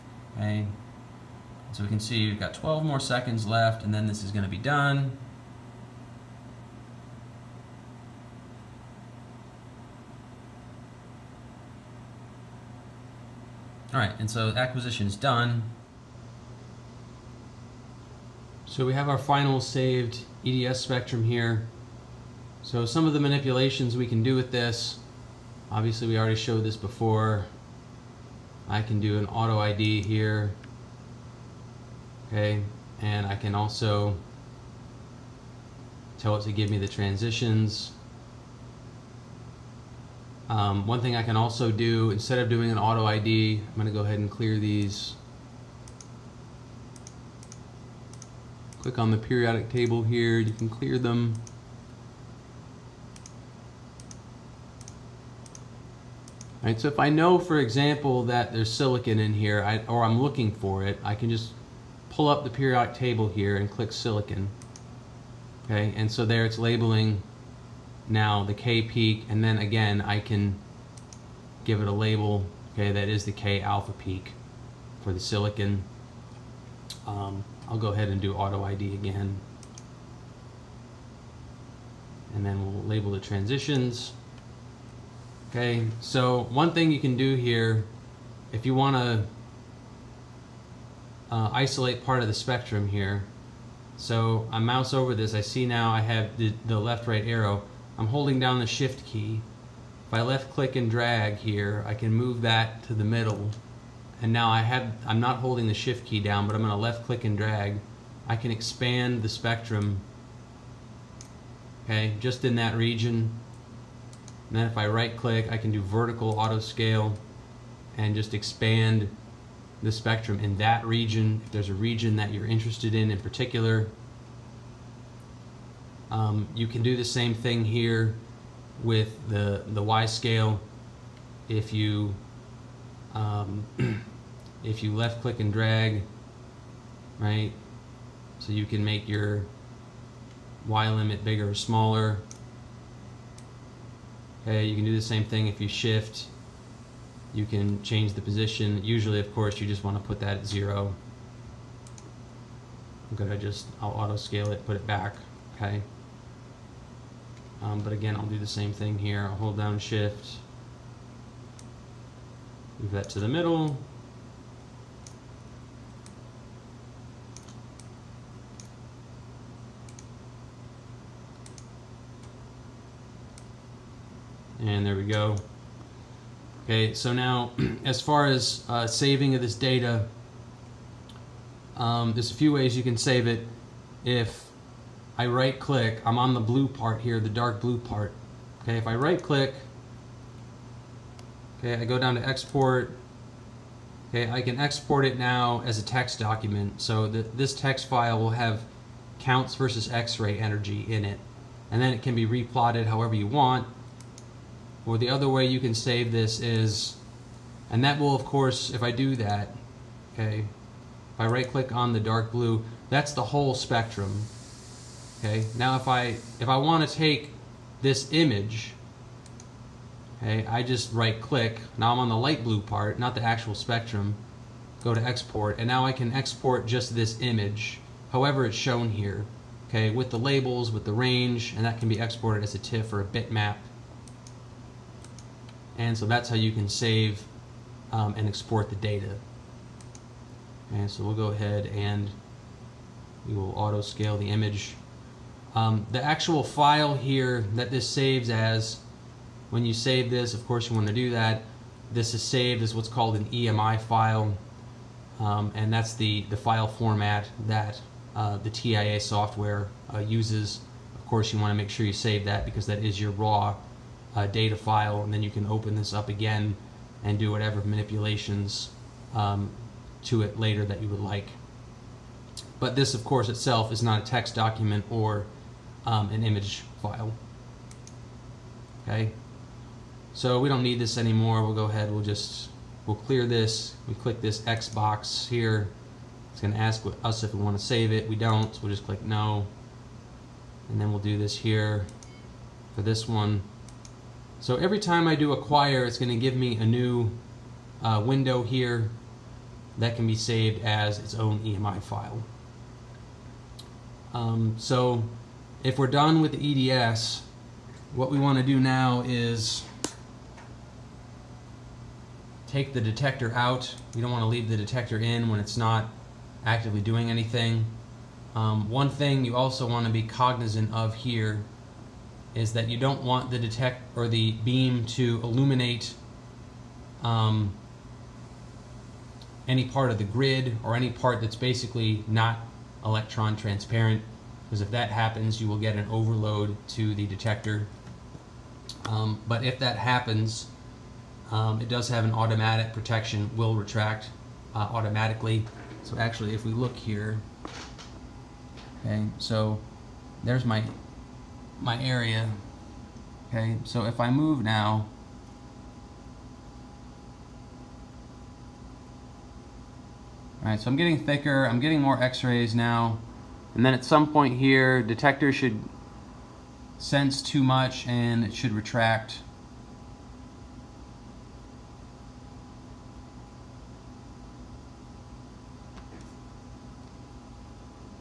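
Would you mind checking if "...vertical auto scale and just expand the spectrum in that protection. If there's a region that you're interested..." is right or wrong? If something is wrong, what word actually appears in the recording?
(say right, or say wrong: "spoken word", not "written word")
wrong: "region", not "protection".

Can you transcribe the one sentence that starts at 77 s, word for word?
Um, I'll go ahead and do auto ID again.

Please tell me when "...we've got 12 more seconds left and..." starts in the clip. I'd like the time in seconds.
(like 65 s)
2 s.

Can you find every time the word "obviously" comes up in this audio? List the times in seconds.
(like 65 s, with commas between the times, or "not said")
25 s.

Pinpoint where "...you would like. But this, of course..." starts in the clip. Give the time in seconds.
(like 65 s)
270 s.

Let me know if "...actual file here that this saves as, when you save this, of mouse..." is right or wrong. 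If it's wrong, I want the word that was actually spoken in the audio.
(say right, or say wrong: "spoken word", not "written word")
wrong: "course", not "mouse".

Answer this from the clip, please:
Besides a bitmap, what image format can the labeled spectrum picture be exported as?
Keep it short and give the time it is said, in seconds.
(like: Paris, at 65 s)
TIFF, at 232 s.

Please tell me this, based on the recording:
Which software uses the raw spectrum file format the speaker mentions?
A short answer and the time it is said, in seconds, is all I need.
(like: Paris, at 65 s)
TIA, at 258 s.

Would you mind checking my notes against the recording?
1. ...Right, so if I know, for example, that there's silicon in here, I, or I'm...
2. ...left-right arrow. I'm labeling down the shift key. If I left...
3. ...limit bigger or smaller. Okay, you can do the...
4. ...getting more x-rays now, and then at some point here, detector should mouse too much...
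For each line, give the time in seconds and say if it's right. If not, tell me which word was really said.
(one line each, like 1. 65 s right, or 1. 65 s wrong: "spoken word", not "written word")
1. 56 s right
2. 96 s wrong: "holding", not "labeling"
3. 140 s right
4. 361 s wrong: "sense", not "mouse".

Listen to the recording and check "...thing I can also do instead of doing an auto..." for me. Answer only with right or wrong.
right.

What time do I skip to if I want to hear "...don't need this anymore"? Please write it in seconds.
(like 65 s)
280 s.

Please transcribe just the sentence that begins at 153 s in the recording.
I'm gonna just, I'll auto scale it, put it back, okay?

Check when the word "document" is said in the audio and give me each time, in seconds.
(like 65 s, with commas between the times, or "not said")
196 s, 274 s.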